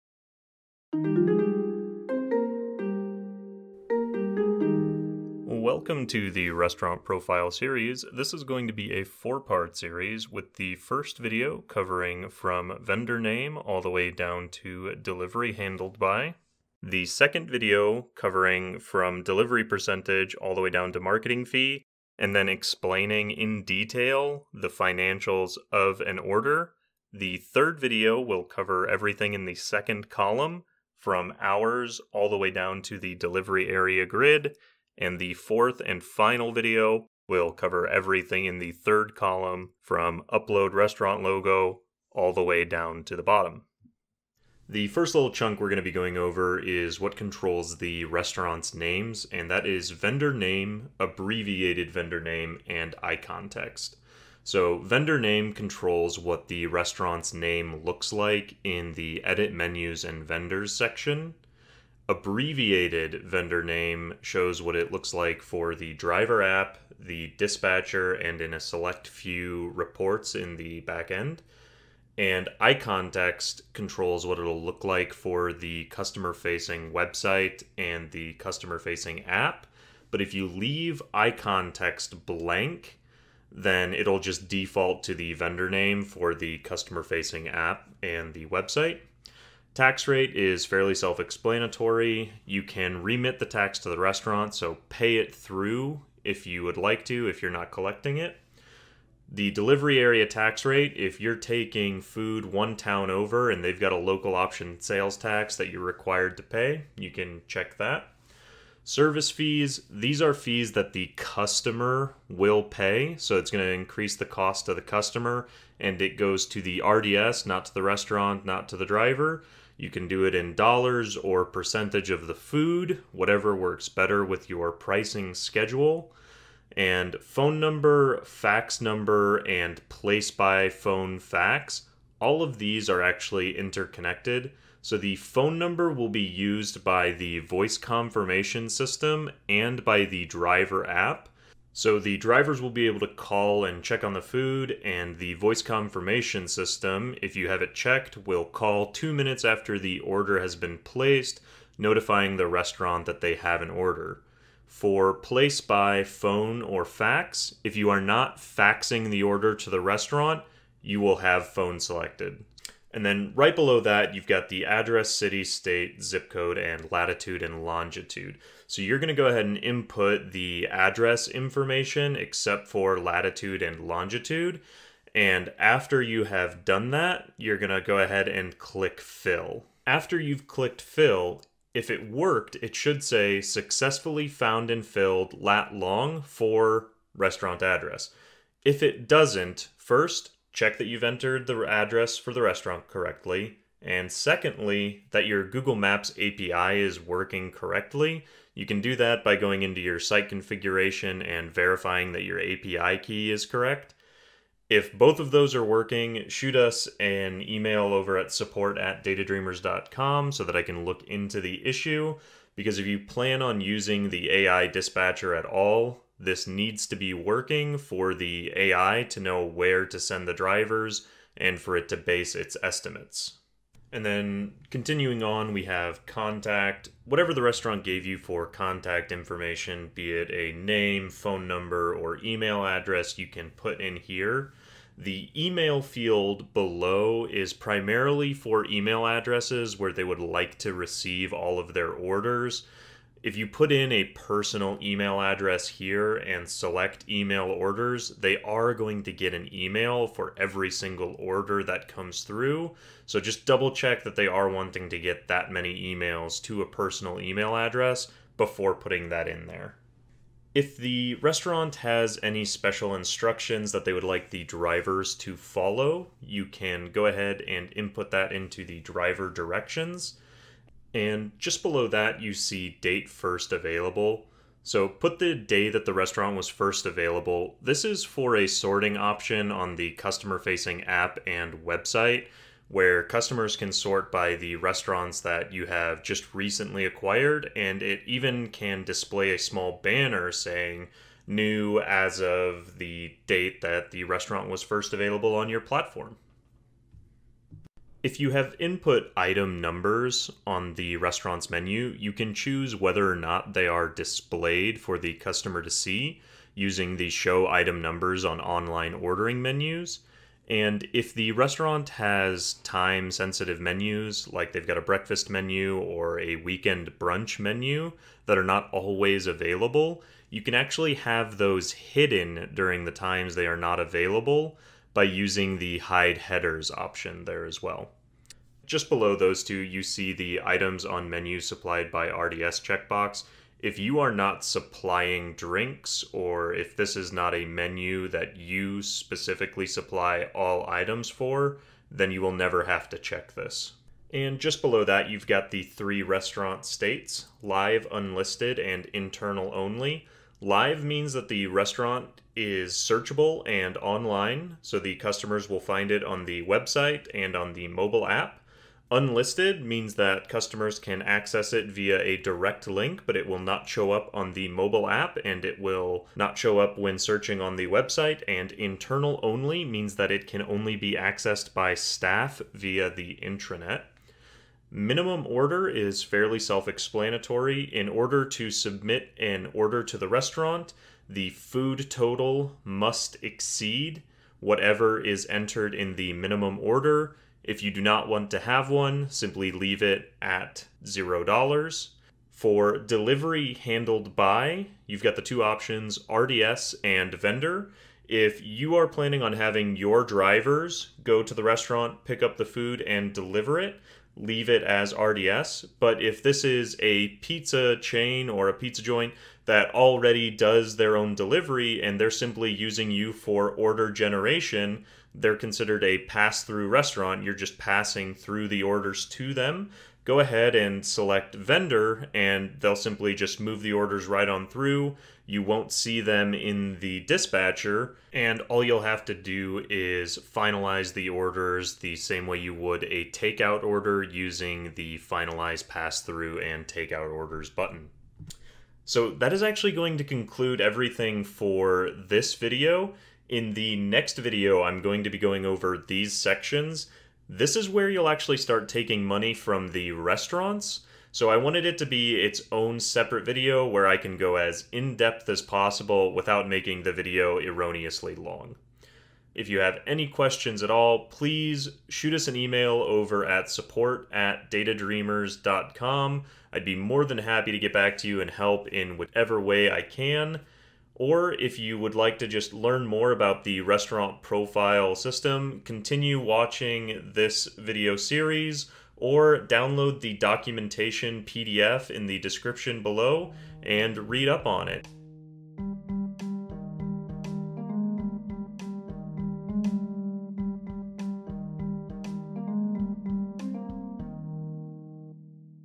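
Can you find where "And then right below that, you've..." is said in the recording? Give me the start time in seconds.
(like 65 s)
162 s.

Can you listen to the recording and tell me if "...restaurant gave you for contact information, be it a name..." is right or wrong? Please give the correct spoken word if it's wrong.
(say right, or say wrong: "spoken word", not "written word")
right.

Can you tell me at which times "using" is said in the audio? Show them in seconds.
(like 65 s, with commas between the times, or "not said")
213 s, 306 s, 325 s, 412 s, 434 s.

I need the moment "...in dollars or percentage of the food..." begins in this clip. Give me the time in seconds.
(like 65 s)
120 s.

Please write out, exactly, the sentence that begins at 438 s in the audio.
So that is actually going to conclude everything for this video.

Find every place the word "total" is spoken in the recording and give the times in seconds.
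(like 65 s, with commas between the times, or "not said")
381 s.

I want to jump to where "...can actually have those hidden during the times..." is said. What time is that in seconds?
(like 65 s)
320 s.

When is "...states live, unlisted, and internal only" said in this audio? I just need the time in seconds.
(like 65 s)
346 s.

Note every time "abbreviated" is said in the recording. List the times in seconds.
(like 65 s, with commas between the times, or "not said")
50 s, 62 s.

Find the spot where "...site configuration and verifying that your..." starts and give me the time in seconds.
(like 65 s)
199 s.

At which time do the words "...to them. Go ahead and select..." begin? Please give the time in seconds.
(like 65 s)
419 s.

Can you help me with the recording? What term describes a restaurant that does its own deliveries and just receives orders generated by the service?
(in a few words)
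Pass through restaurant.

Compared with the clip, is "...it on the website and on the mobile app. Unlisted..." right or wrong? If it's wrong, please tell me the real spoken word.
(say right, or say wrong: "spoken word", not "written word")
right.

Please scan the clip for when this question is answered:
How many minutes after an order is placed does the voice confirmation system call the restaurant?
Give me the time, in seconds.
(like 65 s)
148 s.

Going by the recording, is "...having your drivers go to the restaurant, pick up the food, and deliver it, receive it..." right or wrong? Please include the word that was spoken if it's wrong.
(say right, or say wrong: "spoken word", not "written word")
wrong: "leave", not "receive".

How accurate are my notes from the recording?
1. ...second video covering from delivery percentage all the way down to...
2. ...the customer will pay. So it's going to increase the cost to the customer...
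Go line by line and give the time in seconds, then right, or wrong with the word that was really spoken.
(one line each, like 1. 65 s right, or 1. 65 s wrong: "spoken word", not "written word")
1. 17 s right
2. 110 s right.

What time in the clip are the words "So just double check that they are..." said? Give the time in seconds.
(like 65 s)
253 s.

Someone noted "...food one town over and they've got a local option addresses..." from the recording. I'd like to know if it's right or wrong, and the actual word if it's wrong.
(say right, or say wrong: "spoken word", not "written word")
wrong: "sales", not "addresses".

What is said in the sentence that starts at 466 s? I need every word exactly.
I'd be more than happy to get back to you and help in whatever way I can.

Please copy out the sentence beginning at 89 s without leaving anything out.
Tax rate is fairly self explanatory.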